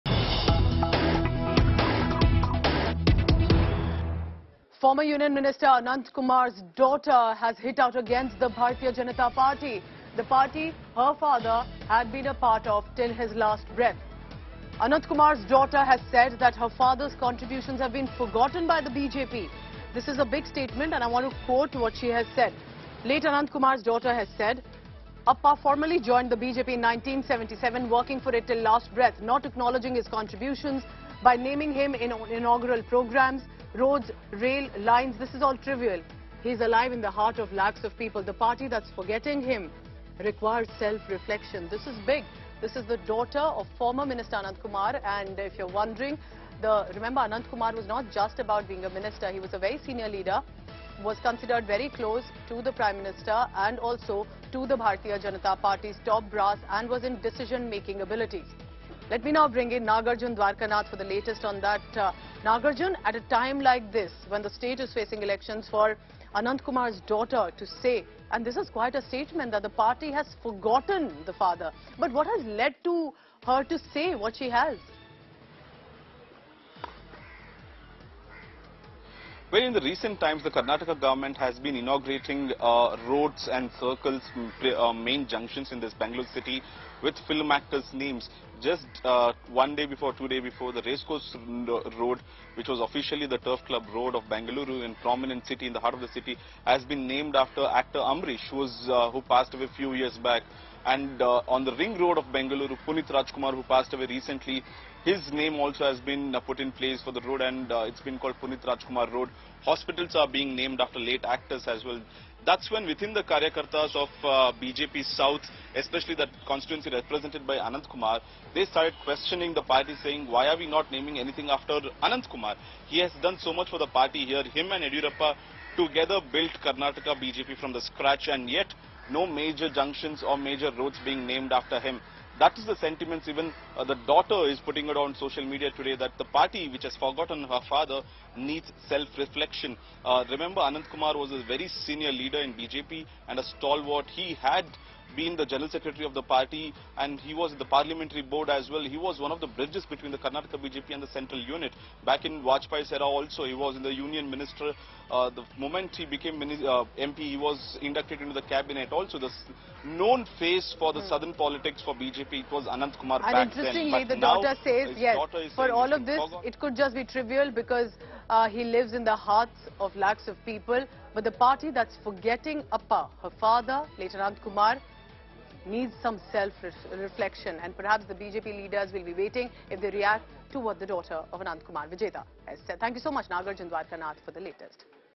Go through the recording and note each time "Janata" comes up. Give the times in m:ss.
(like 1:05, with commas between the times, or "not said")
0:08, 0:55.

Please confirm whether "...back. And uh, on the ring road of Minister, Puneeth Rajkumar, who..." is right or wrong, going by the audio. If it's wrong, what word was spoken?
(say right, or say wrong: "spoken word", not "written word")
wrong: "Bengaluru", not "Minister".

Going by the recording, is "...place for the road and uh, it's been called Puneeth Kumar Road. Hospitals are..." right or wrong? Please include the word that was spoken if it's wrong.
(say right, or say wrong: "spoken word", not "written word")
wrong: "Rajkumar", not "Kumar".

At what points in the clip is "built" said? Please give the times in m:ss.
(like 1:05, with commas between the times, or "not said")
2:06.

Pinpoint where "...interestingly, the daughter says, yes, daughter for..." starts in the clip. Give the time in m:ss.
2:43.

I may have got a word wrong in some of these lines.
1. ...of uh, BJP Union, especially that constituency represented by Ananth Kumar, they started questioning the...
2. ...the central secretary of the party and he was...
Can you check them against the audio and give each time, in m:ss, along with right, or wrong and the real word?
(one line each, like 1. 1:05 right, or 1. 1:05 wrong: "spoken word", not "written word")
1. 1:53 wrong: "South", not "Union"
2. 2:25 wrong: "general", not "central".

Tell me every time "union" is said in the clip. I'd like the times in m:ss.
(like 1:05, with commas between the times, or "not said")
0:05, 2:33.